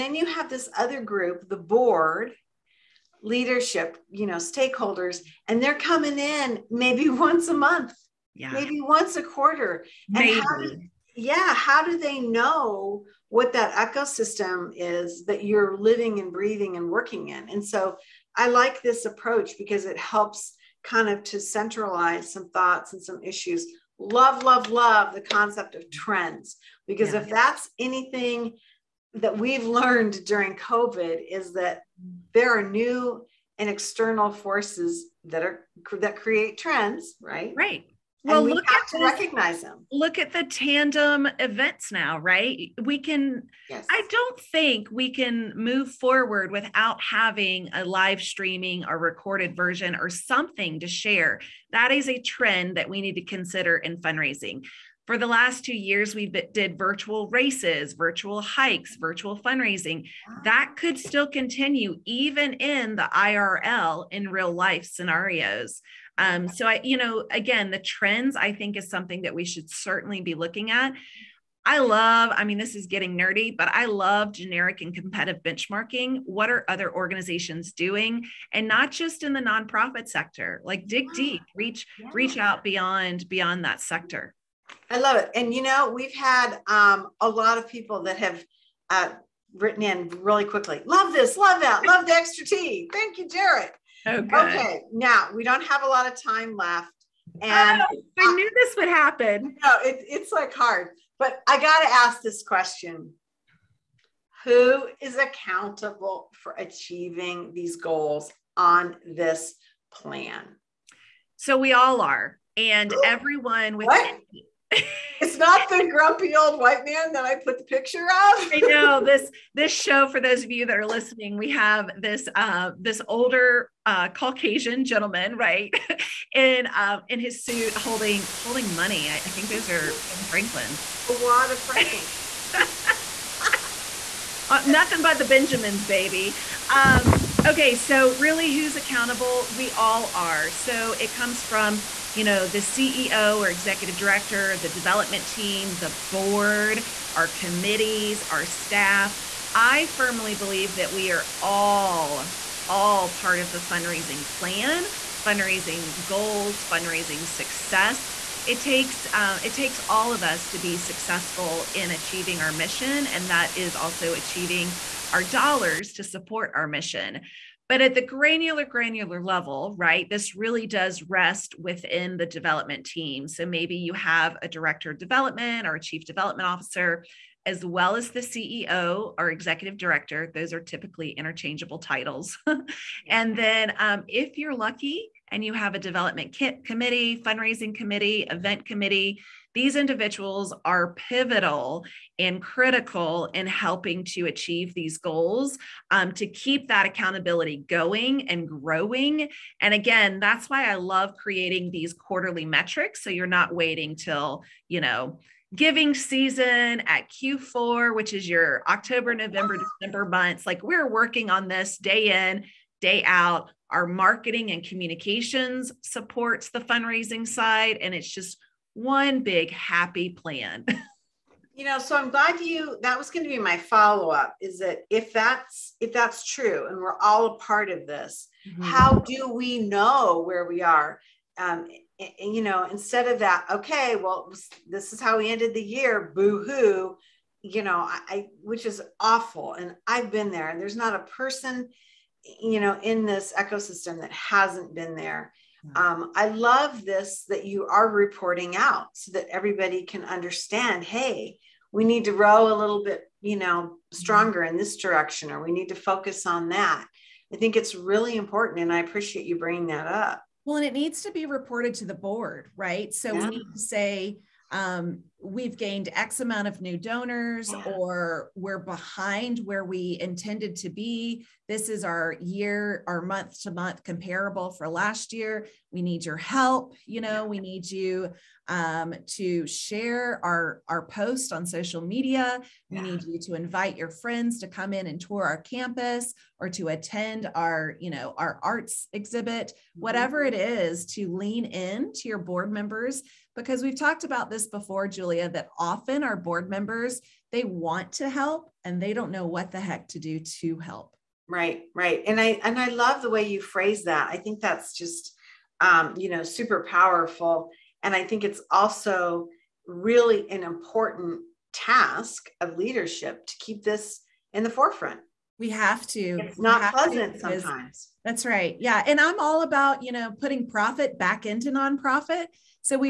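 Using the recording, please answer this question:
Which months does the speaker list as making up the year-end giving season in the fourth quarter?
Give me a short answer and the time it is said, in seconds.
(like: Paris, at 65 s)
October, November, December, at 208 s.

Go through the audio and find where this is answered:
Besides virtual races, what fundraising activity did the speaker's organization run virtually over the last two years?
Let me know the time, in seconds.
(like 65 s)
57 s.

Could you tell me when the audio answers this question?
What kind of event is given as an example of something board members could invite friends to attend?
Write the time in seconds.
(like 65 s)
288 s.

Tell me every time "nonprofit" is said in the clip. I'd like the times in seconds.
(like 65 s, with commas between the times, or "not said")
79 s, 321 s.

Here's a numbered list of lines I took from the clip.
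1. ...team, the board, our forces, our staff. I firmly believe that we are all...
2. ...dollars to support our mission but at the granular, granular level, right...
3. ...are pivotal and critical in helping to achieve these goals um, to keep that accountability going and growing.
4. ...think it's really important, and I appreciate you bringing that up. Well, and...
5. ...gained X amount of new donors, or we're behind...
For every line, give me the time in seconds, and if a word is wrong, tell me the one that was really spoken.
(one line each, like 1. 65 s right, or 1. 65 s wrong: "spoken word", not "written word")
1. 145 s wrong: "committees", not "forces"
2. 165 s right
3. 190 s right
4. 257 s right
5. 265 s right.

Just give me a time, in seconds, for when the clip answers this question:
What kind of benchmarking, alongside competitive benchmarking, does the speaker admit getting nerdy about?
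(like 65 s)
74 s.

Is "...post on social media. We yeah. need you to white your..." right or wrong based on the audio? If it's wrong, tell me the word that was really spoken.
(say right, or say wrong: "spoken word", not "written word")
wrong: "invite", not "white".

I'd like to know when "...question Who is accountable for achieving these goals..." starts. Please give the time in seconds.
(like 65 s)
102 s.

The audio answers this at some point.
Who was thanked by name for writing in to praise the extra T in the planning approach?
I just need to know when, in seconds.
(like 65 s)
93 s.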